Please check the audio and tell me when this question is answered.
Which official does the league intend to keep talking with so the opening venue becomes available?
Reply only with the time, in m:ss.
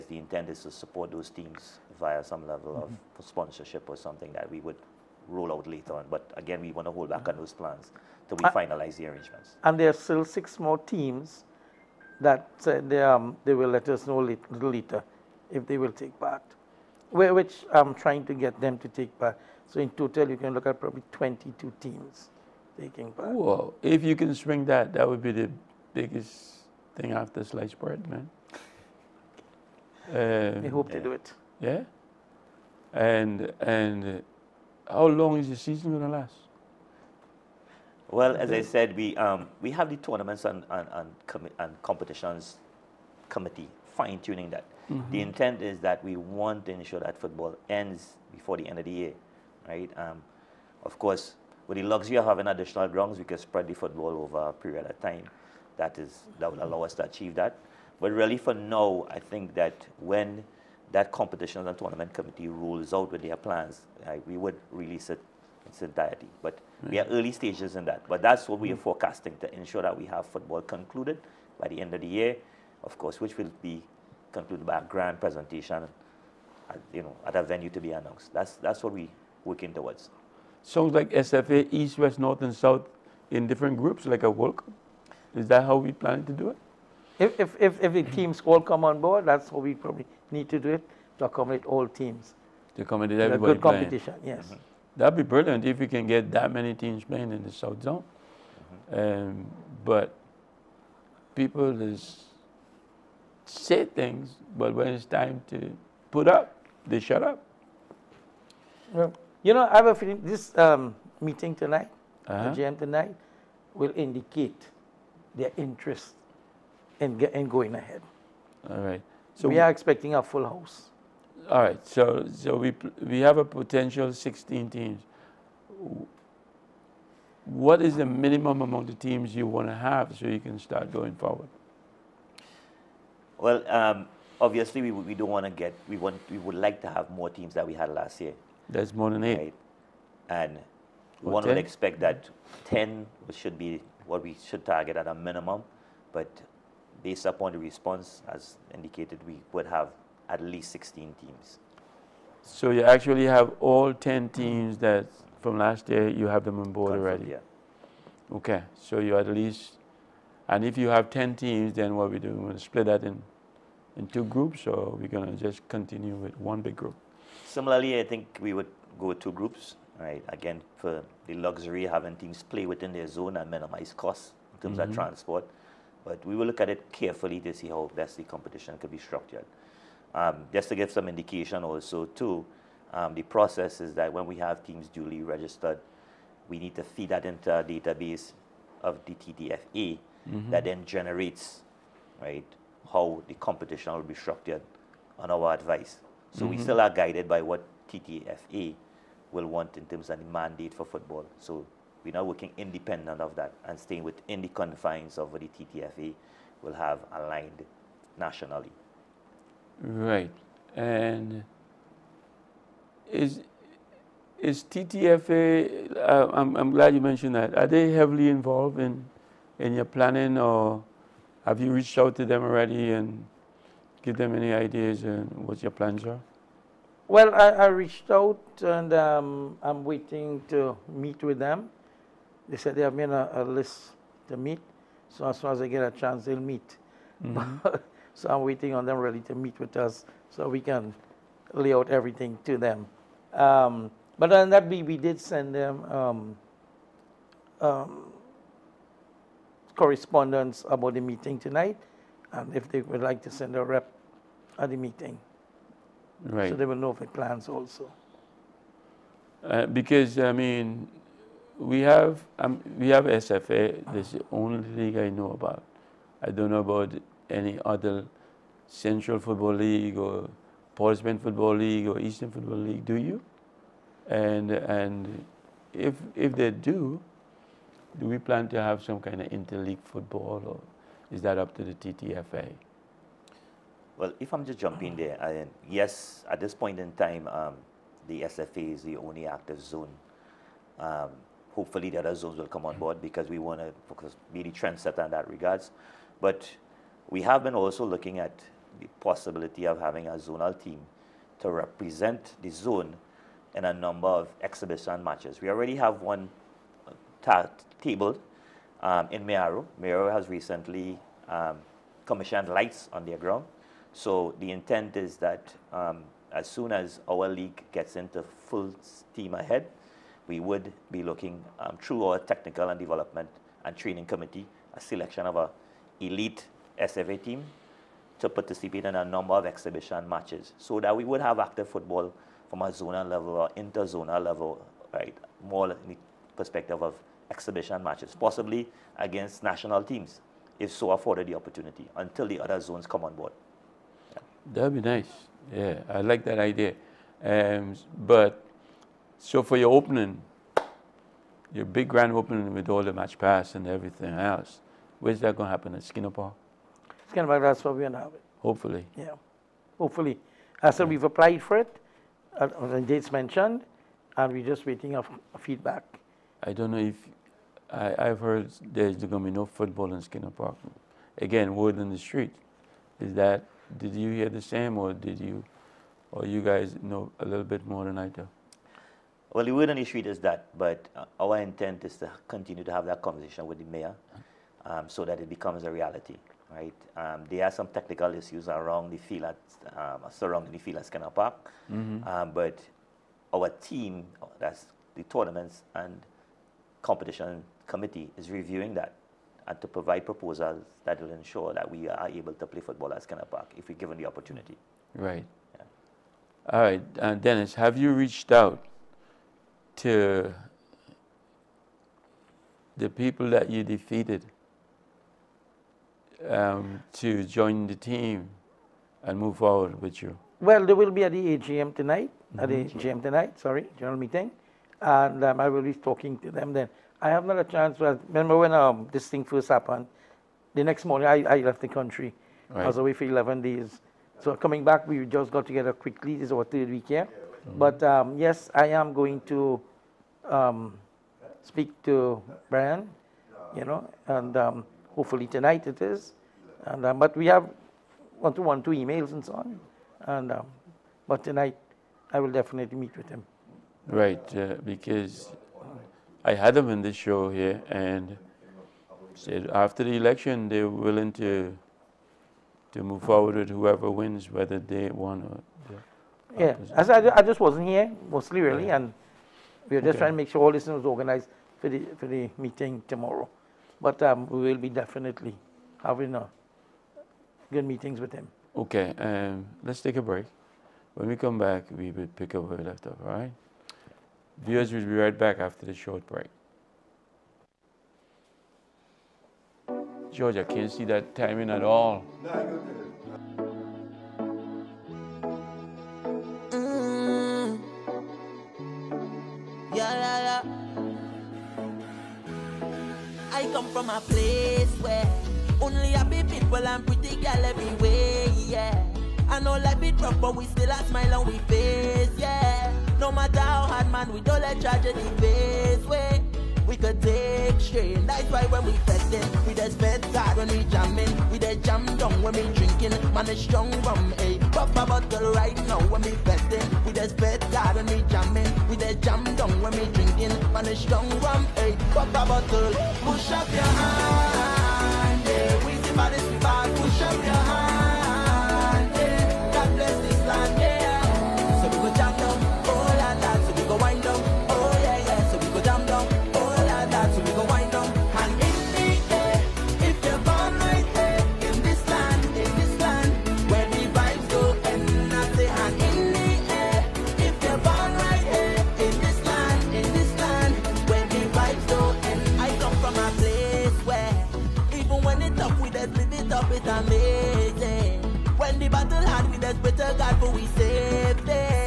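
6:23.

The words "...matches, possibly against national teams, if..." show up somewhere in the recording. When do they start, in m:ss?
5:37.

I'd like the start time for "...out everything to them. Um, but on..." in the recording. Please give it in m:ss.
4:01.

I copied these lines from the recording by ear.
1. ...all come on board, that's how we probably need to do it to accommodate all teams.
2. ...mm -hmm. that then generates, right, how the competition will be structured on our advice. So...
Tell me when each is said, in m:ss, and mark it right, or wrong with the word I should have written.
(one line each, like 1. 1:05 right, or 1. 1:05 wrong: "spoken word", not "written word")
1. 1:28 right
2. 3:10 right.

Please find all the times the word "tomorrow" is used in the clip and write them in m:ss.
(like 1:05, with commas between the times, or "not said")
7:52.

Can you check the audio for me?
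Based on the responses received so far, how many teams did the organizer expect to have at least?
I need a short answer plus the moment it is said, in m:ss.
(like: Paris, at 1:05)
16, at 2:30.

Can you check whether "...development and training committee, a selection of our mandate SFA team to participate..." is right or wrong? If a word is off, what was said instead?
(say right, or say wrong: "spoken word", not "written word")
wrong: "elite", not "mandate".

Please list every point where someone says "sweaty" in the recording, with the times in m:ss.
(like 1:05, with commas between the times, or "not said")
not said.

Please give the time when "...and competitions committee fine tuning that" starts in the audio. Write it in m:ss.
0:41.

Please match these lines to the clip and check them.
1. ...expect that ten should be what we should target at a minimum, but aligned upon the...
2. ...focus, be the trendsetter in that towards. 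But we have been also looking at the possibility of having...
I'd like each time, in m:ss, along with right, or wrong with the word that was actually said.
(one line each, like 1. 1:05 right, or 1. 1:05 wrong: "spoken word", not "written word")
1. 2:21 wrong: "based", not "aligned"
2. 4:53 wrong: "regards", not "towards".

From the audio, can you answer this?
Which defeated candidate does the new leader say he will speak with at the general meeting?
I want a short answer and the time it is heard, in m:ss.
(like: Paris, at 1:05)
Brian, at 7:22.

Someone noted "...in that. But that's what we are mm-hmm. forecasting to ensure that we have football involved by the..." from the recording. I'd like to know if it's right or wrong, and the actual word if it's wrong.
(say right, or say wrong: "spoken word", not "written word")
wrong: "concluded", not "involved".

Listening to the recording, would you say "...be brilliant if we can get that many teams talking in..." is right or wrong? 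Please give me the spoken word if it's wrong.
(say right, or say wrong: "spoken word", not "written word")
wrong: "playing", not "talking".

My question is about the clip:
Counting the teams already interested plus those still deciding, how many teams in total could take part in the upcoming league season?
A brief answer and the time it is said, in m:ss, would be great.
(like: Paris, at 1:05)
22, at 0:21.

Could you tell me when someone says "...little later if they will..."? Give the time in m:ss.
0:14.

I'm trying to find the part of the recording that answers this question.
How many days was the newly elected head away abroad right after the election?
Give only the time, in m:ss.
7:13.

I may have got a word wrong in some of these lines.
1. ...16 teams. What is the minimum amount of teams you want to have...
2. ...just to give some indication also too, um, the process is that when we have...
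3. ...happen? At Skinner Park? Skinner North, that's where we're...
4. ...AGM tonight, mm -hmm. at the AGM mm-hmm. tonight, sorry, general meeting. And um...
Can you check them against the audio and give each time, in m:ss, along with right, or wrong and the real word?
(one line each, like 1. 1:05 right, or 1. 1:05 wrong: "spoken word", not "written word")
1. 2:04 right
2. 3:00 right
3. 5:55 wrong: "Park", not "North"
4. 7:01 right.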